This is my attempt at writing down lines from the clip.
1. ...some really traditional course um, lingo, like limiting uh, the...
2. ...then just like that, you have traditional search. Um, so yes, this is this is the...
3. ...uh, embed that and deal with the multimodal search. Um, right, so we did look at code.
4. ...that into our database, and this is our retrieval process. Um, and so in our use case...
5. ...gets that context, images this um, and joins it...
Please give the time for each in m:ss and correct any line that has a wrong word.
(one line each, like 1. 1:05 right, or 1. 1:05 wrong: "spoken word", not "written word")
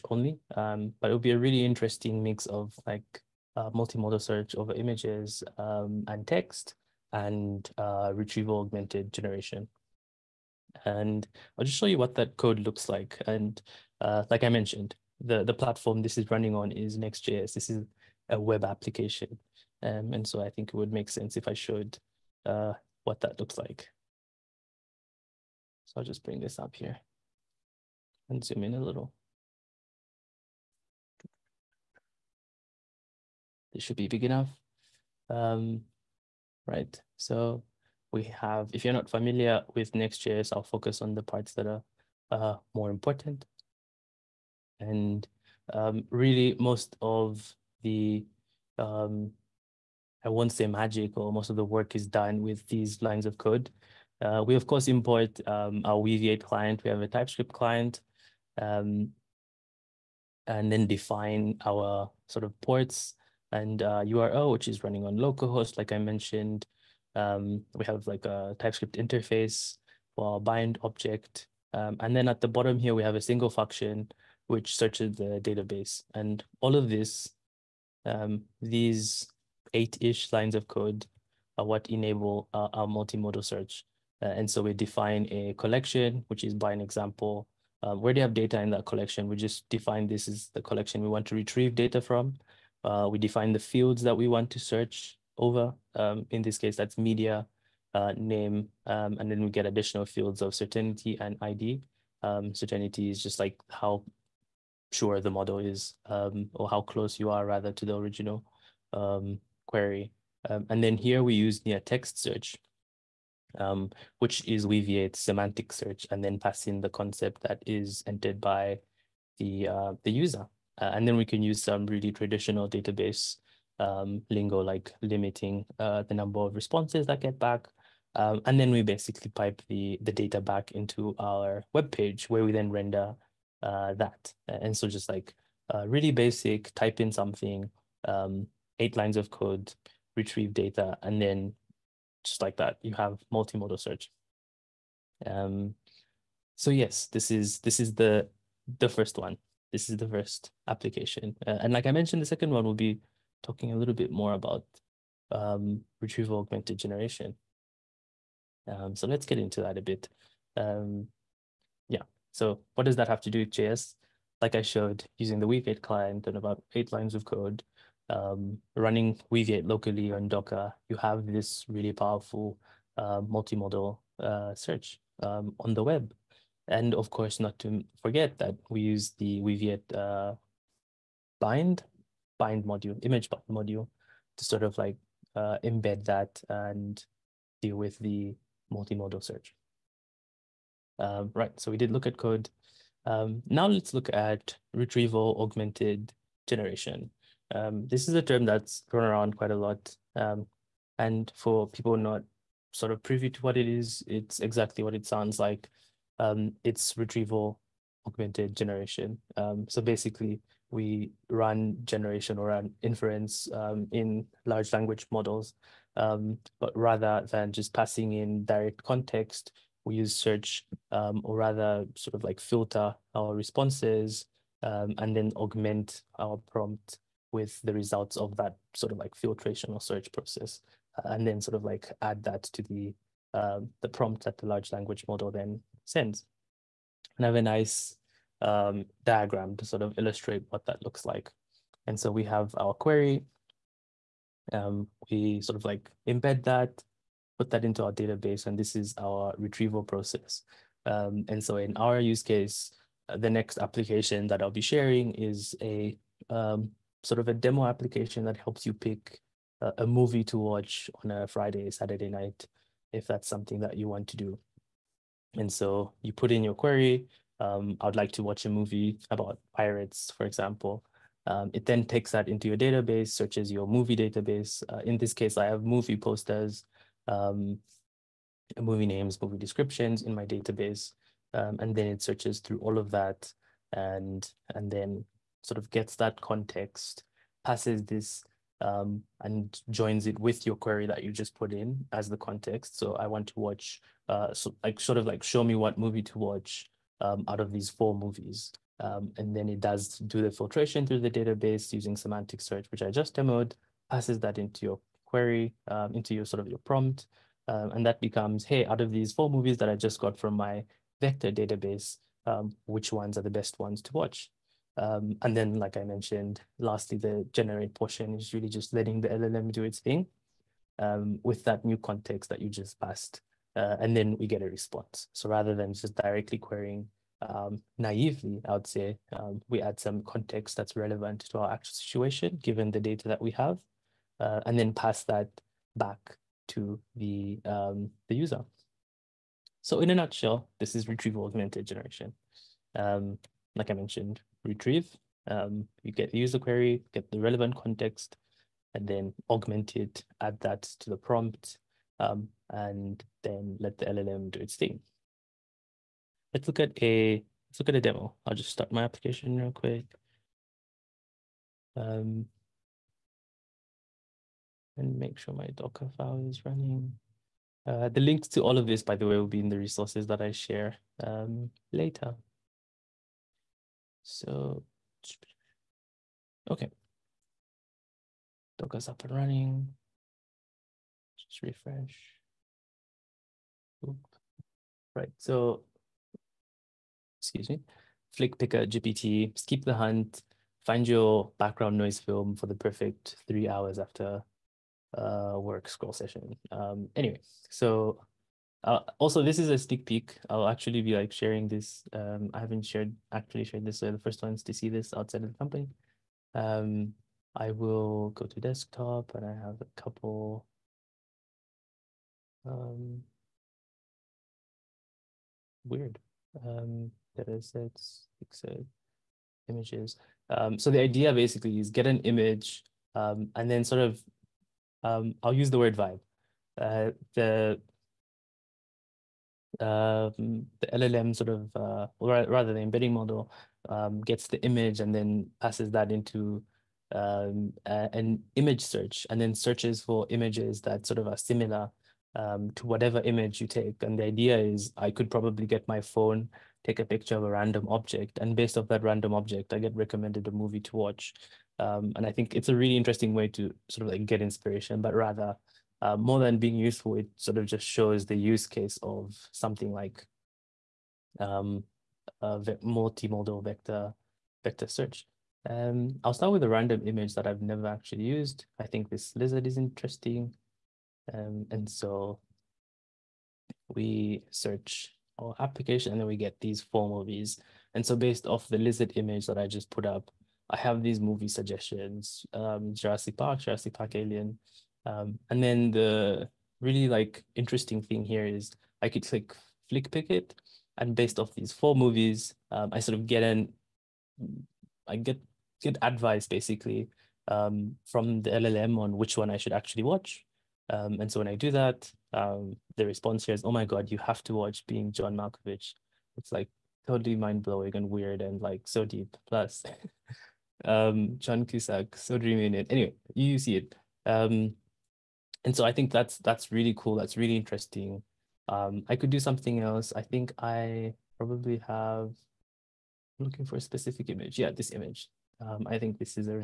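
1. 2:01 wrong: "database", not "course"
2. 2:21 wrong: "multimodal", not "traditional"
3. 3:05 right
4. 4:07 right
5. 4:45 wrong: "passes", not "images".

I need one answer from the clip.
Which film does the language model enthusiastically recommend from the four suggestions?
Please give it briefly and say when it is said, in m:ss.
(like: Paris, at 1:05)
Being John Malkovich, at 8:24.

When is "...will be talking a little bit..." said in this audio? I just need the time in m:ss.
2:32.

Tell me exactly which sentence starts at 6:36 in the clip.
Um, anyway, so uh, also, this is a sneak peek.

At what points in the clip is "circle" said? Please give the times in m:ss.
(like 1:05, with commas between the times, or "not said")
not said.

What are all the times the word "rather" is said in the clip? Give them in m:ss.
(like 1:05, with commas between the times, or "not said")
1:47, 3:36, 3:41, 5:25, 7:12, 7:34.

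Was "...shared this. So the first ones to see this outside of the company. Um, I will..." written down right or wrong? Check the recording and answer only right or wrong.
right.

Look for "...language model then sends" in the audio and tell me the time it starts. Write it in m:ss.
3:54.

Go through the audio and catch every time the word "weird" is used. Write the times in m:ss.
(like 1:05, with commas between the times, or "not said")
6:55, 8:27.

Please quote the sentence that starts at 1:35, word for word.
Um, in this case, that's media, uh, name, um, and then we get additional fields of certainty and ID.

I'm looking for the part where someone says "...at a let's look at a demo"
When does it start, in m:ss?
5:56.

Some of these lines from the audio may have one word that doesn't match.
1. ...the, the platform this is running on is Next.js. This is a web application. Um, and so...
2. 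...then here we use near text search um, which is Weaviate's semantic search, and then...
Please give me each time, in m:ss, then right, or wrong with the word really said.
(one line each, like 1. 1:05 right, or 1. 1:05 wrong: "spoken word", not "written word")
1. 0:15 right
2. 1:50 right.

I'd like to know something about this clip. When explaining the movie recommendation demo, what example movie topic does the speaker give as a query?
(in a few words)
pirates.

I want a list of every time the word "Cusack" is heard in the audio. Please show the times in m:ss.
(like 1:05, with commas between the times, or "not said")
8:31.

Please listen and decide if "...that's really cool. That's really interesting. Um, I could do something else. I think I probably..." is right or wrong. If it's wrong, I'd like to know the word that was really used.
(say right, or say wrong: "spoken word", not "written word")
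right.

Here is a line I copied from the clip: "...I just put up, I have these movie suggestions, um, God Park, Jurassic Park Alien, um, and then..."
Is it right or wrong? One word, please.
wrong.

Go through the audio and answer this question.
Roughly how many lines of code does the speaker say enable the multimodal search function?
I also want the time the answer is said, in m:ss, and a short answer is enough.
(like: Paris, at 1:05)
8, at 1:19.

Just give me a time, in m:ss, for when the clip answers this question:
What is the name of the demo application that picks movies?
6:28.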